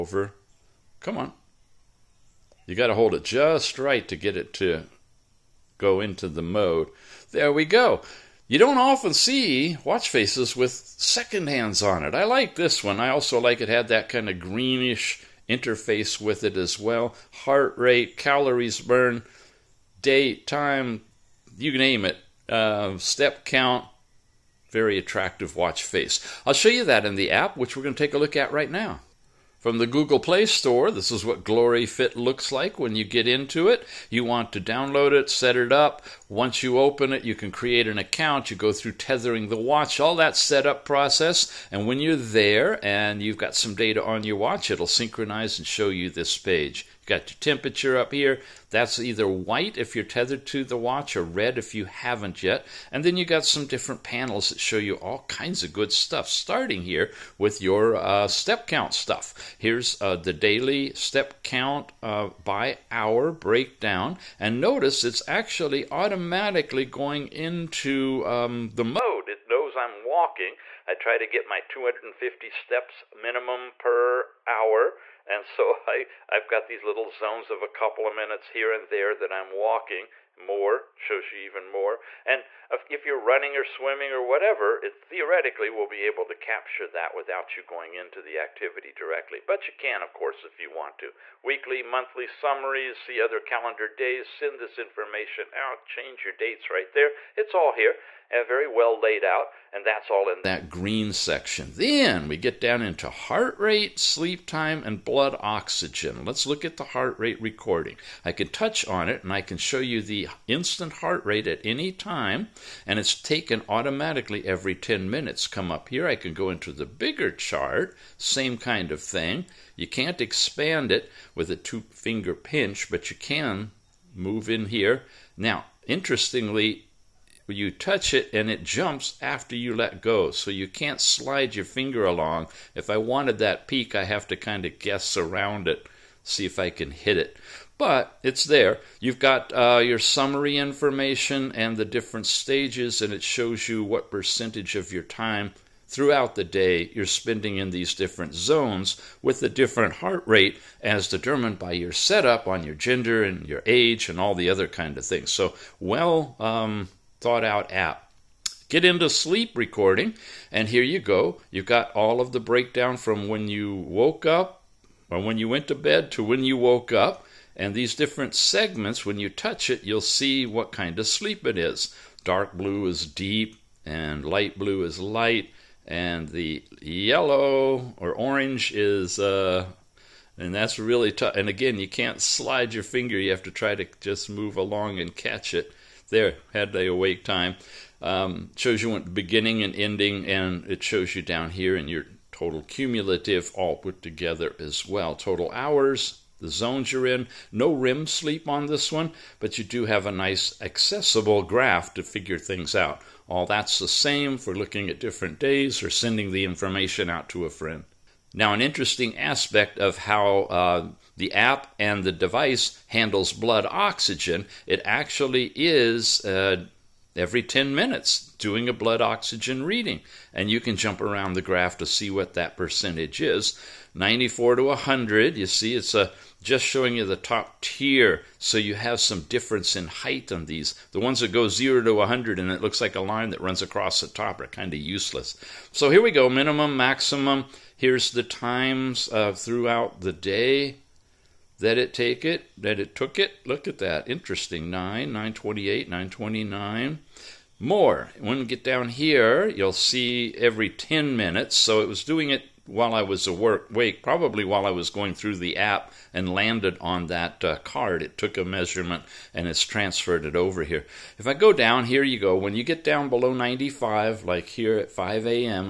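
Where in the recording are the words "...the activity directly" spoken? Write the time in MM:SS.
01:28.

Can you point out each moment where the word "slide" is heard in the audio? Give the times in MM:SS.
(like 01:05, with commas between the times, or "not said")
02:11, 03:02.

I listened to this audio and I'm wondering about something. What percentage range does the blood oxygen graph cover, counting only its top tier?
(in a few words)
94 to 100.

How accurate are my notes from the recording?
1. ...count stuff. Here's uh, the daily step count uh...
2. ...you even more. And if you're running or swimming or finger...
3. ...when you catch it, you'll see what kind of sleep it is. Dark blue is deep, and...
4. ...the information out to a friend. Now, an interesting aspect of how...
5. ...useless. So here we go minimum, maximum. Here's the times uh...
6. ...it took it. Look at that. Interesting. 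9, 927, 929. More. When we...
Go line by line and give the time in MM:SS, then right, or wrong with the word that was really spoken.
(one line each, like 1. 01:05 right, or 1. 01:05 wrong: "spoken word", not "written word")
1. 00:58 right
2. 01:21 wrong: "whatever", not "finger"
3. 02:49 wrong: "touch", not "catch"
4. 03:26 right
5. 03:54 right
6. 04:02 wrong: "928", not "927".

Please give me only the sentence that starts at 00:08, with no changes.
You don't often see watch faces with second hands on it.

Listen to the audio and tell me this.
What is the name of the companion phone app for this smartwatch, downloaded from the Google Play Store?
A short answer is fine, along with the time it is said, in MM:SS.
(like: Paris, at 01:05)
Glory Fit, at 00:31.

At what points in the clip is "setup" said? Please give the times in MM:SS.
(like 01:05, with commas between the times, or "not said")
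00:40, 02:31.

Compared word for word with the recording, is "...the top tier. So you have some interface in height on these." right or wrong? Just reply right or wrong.
wrong.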